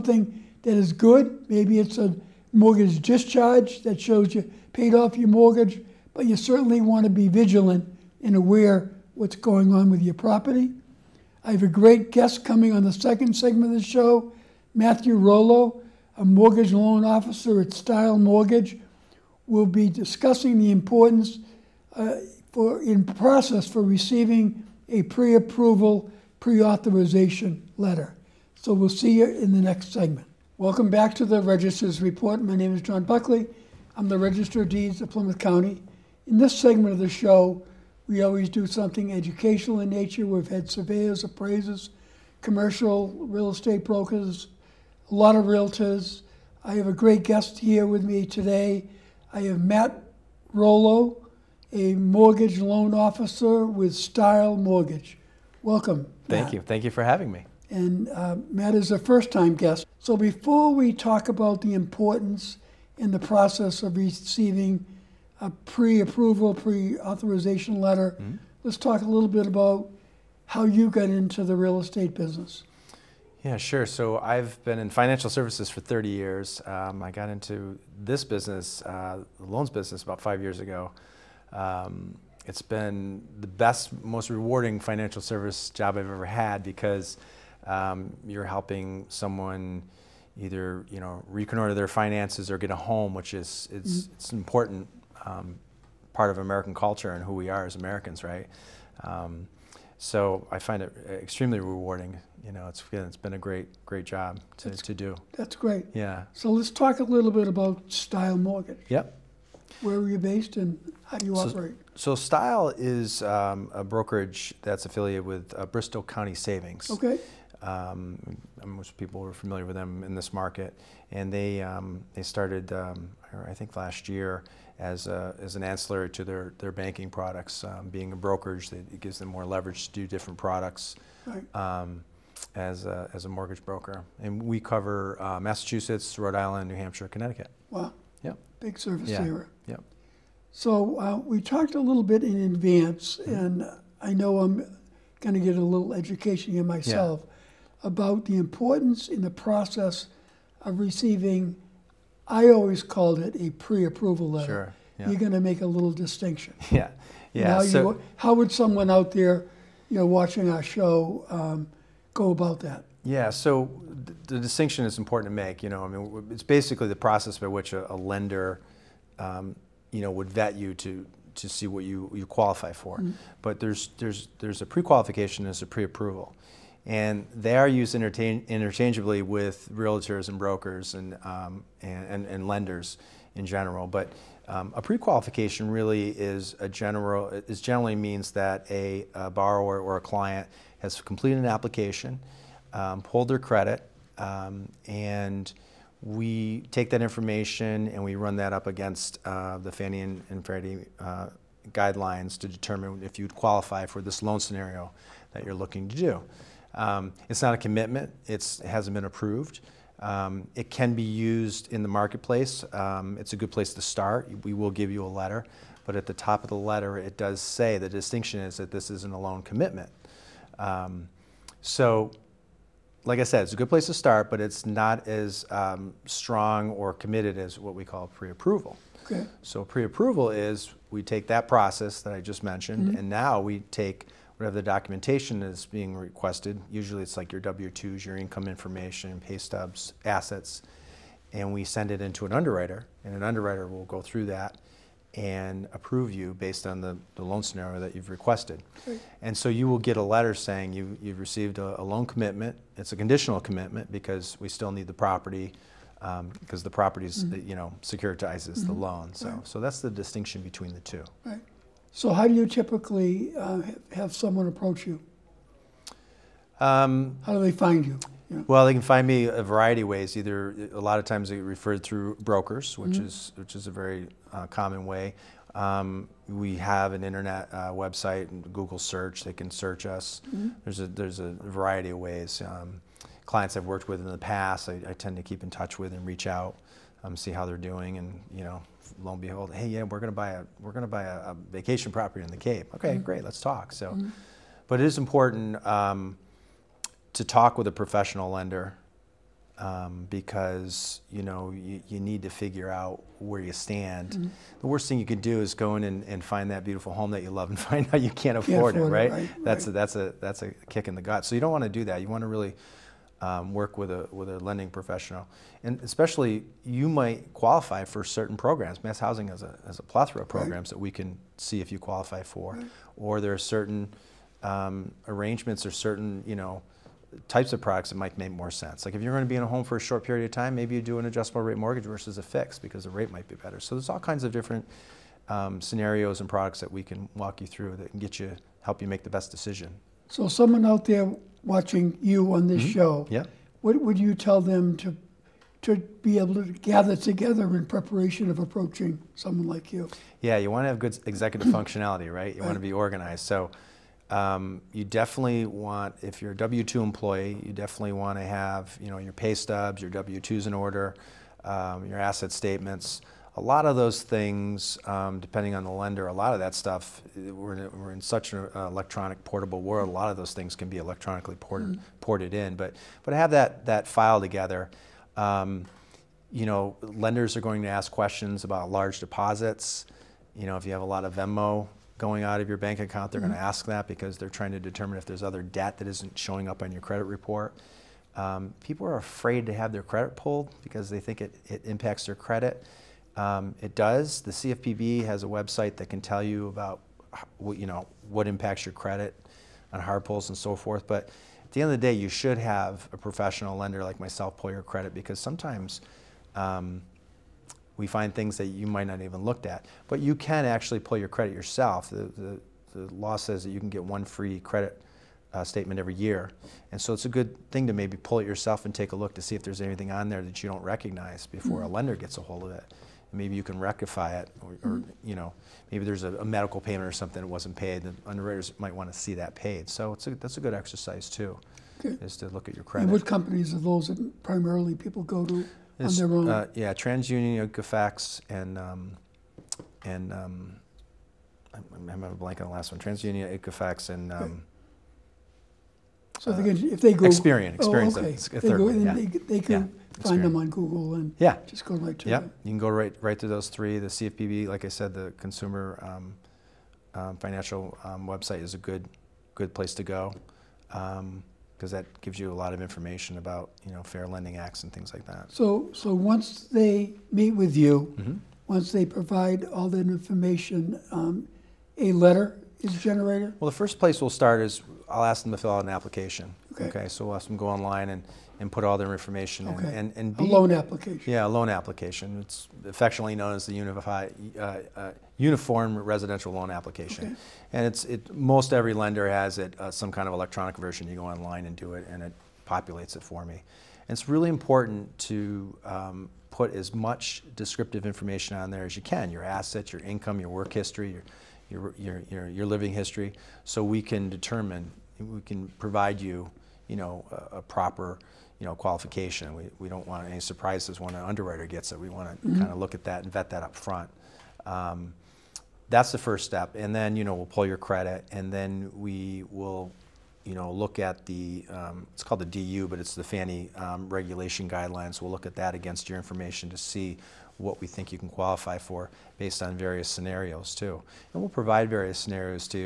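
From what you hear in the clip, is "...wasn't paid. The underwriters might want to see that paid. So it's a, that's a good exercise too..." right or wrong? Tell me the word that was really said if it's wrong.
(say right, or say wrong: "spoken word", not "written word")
right.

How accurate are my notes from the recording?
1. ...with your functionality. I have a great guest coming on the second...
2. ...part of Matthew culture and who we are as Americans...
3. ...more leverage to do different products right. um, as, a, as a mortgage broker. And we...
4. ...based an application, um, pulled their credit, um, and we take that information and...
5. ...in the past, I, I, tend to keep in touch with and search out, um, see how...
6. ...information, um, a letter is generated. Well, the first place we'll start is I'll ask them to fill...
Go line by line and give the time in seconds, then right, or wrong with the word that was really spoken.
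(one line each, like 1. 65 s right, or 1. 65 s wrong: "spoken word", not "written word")
1. 9 s wrong: "property", not "functionality"
2. 96 s wrong: "American", not "Matthew"
3. 129 s right
4. 190 s wrong: "completed", not "based"
5. 284 s wrong: "reach", not "search"
6. 469 s right.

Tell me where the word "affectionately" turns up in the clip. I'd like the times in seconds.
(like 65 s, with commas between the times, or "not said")
482 s.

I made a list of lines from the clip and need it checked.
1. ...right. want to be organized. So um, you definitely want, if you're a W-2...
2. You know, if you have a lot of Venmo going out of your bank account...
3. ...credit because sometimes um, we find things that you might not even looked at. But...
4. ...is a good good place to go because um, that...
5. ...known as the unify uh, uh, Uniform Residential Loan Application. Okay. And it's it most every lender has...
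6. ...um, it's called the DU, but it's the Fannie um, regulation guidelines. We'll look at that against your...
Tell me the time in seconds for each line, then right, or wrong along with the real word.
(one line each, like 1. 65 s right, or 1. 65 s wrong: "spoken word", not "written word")
1. 352 s right
2. 380 s right
3. 404 s right
4. 458 s right
5. 483 s right
6. 521 s right.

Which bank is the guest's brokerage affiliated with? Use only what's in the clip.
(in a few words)
Bristol County Savings.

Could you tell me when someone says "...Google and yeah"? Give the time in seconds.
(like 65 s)
450 s.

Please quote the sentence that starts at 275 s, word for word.
Um, we have an internet uh, website and Google search.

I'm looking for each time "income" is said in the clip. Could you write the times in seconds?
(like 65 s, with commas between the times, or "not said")
238 s, 499 s.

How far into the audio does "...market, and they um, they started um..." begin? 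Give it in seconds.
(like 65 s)
120 s.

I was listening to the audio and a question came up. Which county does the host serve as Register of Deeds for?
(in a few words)
Plymouth County.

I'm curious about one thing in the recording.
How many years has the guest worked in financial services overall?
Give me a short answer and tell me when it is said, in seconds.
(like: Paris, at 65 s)
30, at 75 s.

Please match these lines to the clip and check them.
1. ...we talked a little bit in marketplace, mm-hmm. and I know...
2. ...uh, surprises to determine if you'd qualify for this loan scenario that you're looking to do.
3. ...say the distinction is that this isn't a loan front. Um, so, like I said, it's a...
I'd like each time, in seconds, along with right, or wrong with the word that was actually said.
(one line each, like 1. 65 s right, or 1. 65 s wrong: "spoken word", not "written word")
1. 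141 s wrong: "advance", not "marketplace"
2. 200 s wrong: "guidelines", not "surprises"
3. 217 s wrong: "commitment", not "front".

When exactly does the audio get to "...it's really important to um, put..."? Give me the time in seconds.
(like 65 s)
493 s.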